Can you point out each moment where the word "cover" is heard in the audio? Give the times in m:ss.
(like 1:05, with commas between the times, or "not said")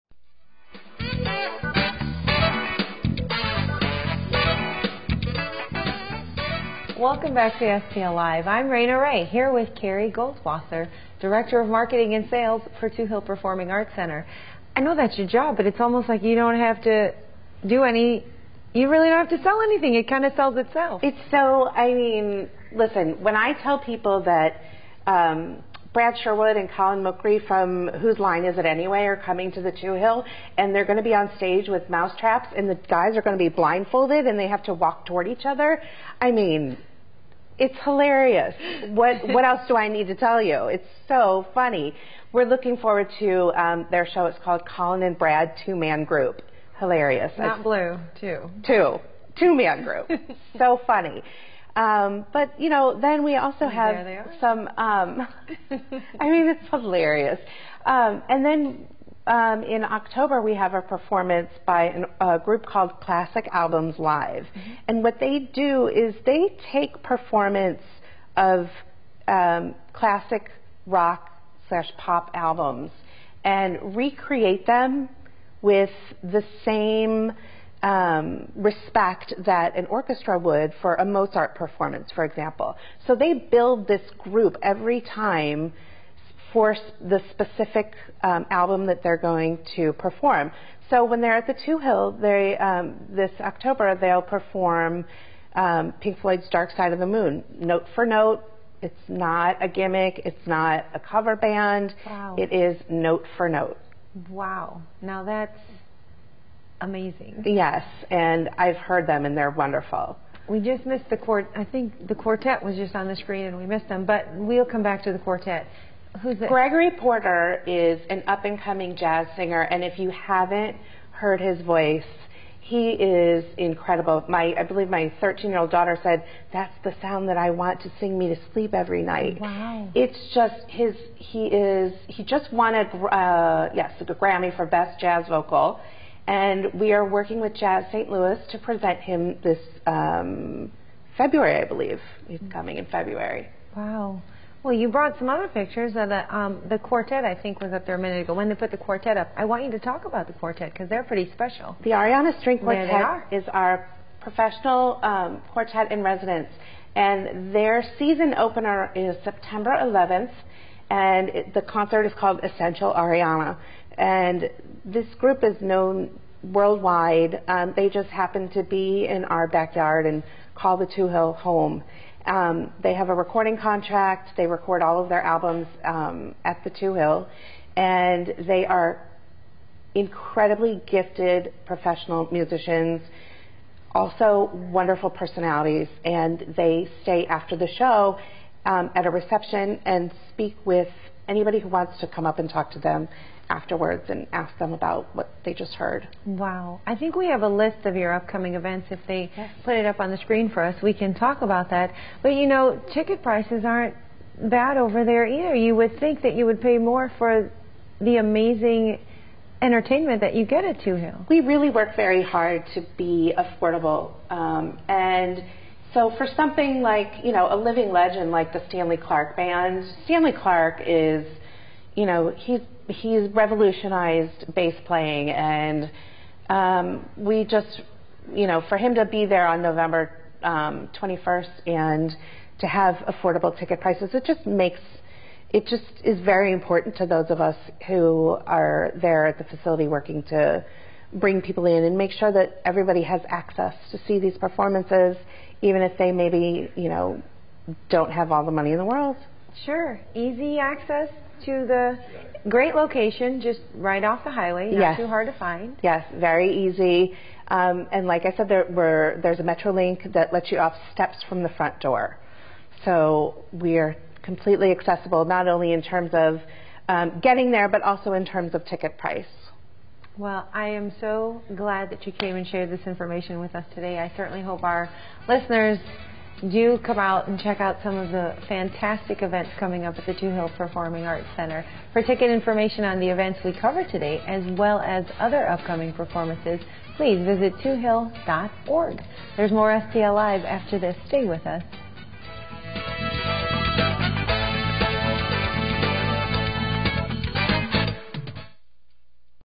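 1:40, 4:43.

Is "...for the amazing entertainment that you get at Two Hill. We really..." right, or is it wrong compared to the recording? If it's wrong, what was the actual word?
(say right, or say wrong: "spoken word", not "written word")
right.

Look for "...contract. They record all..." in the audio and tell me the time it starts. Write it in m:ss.
2:53.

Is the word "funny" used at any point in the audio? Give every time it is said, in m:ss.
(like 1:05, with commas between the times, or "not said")
0:41, 0:50.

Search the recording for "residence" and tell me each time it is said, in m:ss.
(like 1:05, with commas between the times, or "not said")
2:36.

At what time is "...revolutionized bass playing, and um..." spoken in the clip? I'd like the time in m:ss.
3:43.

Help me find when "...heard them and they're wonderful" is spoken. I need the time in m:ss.
1:48.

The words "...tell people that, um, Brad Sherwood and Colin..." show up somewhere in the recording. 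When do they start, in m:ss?
0:23.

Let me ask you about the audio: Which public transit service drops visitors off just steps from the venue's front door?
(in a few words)
Metrolink.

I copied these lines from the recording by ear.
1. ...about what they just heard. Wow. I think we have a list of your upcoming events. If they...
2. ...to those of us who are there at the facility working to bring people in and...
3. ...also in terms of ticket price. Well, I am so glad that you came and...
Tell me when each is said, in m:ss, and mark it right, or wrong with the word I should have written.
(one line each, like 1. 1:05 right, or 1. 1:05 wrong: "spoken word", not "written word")
1. 3:14 right
2. 3:56 right
3. 4:27 right.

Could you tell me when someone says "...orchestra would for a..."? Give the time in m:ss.
1:19.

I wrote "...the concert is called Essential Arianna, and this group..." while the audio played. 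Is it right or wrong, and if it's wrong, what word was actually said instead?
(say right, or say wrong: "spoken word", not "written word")
right.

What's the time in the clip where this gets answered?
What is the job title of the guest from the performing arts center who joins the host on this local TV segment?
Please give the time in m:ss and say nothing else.
0:11.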